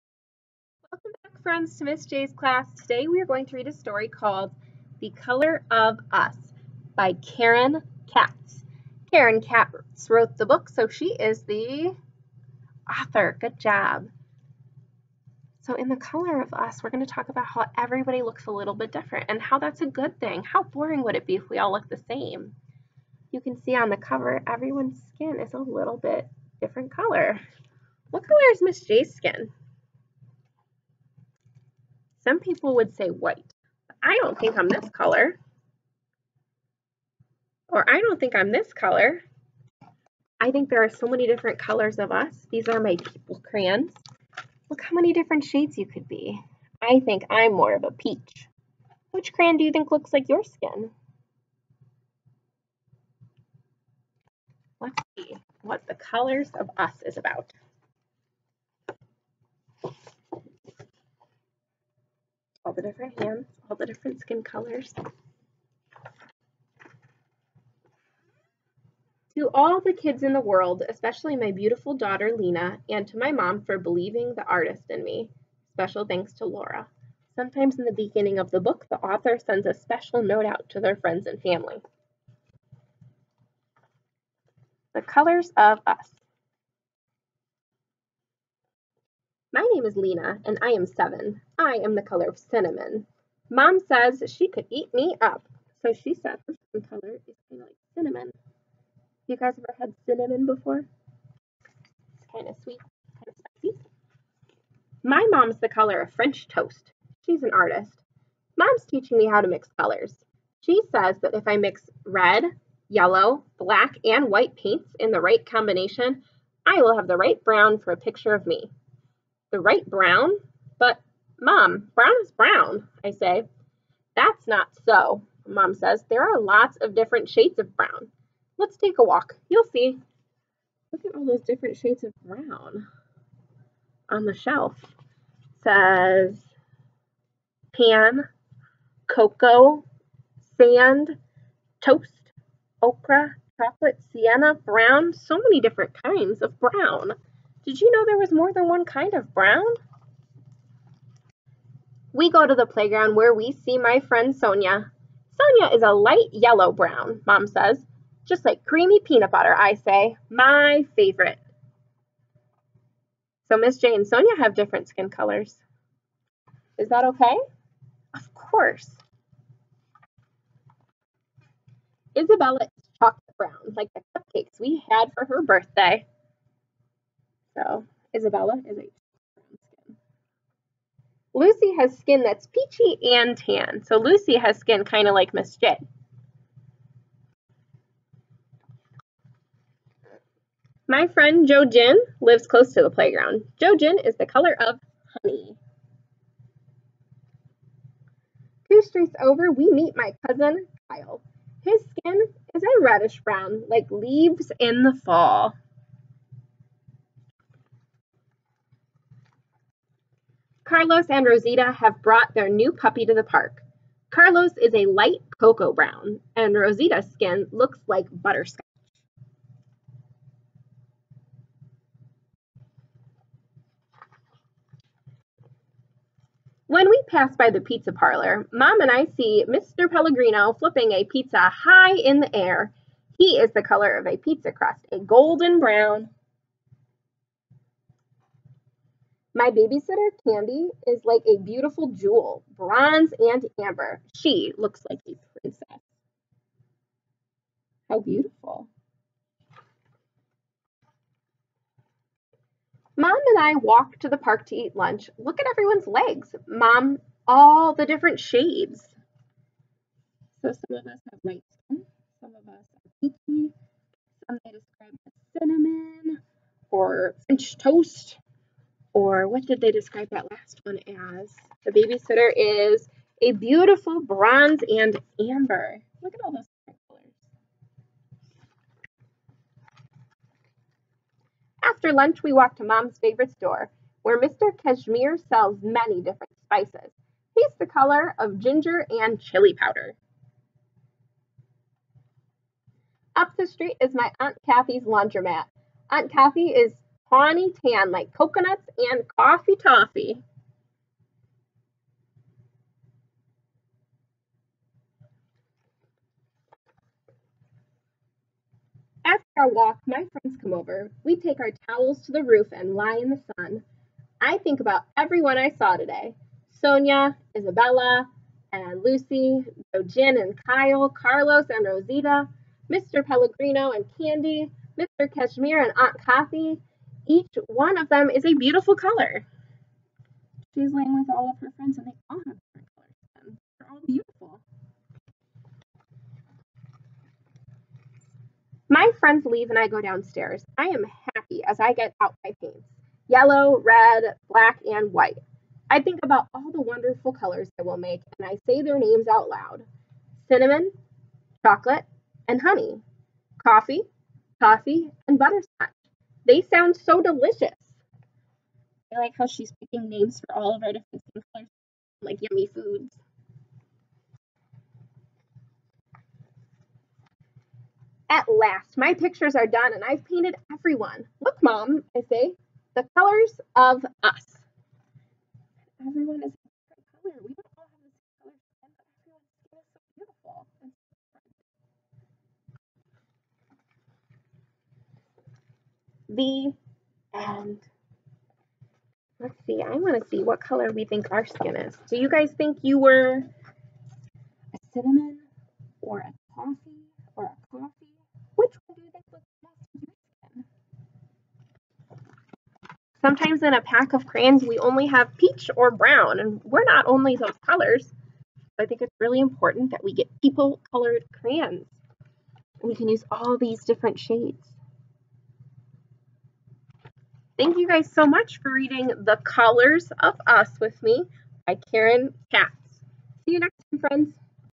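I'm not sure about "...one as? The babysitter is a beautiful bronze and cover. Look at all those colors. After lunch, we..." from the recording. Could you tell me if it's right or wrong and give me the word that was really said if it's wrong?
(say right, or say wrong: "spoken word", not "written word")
wrong: "amber", not "cover".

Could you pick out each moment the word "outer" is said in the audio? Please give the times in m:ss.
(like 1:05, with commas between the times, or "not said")
not said.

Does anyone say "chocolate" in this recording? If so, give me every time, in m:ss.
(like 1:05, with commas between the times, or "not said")
2:23, 2:52, 5:51.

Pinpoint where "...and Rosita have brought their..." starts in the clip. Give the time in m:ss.
3:31.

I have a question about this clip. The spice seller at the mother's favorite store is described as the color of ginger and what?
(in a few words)
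chili powder.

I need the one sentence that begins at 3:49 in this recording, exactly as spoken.
Pellegrino flipping a pizza high in the air.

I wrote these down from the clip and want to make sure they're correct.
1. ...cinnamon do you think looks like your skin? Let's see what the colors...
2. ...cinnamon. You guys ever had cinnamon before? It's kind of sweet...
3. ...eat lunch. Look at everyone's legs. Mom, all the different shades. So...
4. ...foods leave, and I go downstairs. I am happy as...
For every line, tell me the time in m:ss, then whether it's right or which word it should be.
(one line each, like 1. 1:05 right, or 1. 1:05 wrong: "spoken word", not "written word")
1. 0:49 wrong: "crayon", not "cinnamon"
2. 1:37 right
3. 4:14 right
4. 5:38 wrong: "friends", not "foods".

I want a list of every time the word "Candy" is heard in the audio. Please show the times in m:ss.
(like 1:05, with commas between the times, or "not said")
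4:00, 5:23.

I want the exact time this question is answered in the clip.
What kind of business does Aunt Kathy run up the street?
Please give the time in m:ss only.
4:54.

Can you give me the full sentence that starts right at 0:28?
What color is Miss J's skin?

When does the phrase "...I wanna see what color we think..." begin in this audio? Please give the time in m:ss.
6:29.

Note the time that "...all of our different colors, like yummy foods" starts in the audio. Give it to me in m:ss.
6:00.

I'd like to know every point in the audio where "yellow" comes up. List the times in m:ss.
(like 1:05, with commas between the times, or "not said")
1:52, 2:36, 5:43.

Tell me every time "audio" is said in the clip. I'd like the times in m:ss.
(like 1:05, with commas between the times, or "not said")
not said.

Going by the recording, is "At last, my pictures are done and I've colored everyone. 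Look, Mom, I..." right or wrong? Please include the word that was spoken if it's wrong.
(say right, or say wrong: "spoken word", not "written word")
wrong: "painted", not "colored".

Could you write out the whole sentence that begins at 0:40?
I think there are so many different colors of us.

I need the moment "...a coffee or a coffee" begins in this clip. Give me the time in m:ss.
6:35.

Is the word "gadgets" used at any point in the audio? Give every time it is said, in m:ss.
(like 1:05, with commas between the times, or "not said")
not said.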